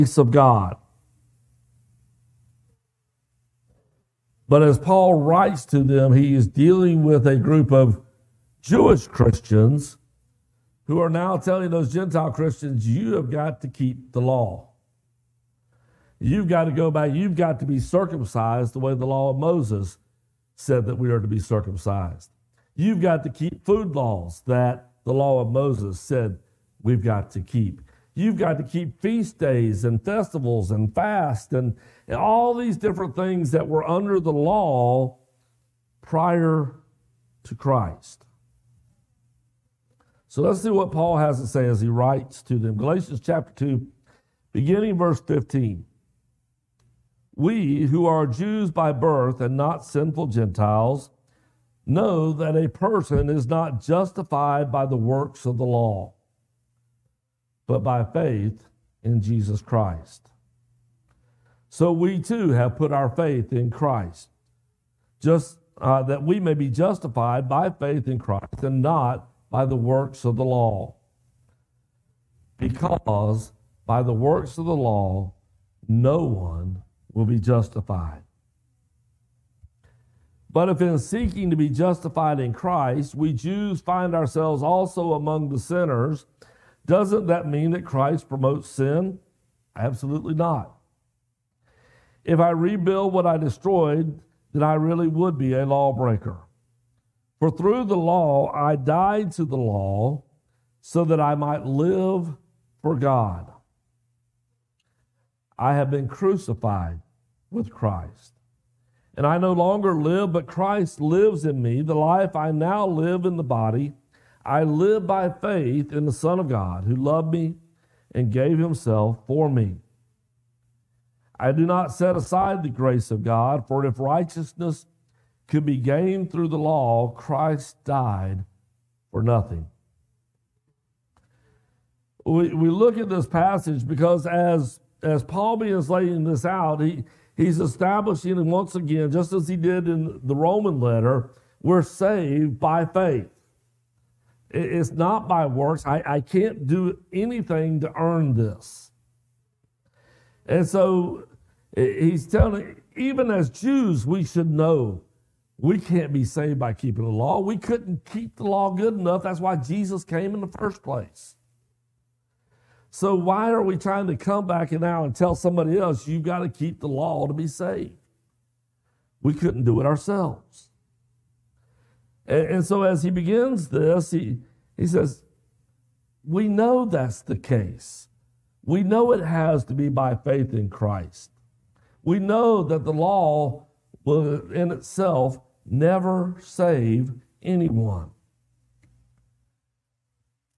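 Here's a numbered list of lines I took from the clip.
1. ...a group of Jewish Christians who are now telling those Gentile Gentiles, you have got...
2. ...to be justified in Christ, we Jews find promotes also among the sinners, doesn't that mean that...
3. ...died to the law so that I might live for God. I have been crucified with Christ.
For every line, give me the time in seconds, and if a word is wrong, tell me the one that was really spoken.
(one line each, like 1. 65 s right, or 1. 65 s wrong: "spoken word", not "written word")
1. 7 s wrong: "Christians", not "Gentiles"
2. 81 s wrong: "ourselves", not "promotes"
3. 98 s right.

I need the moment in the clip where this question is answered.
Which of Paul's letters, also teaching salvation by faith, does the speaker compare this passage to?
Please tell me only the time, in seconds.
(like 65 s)
140 s.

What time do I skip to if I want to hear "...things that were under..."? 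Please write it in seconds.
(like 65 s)
33 s.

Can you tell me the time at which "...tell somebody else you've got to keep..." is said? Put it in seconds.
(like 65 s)
165 s.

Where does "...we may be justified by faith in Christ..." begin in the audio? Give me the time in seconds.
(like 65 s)
66 s.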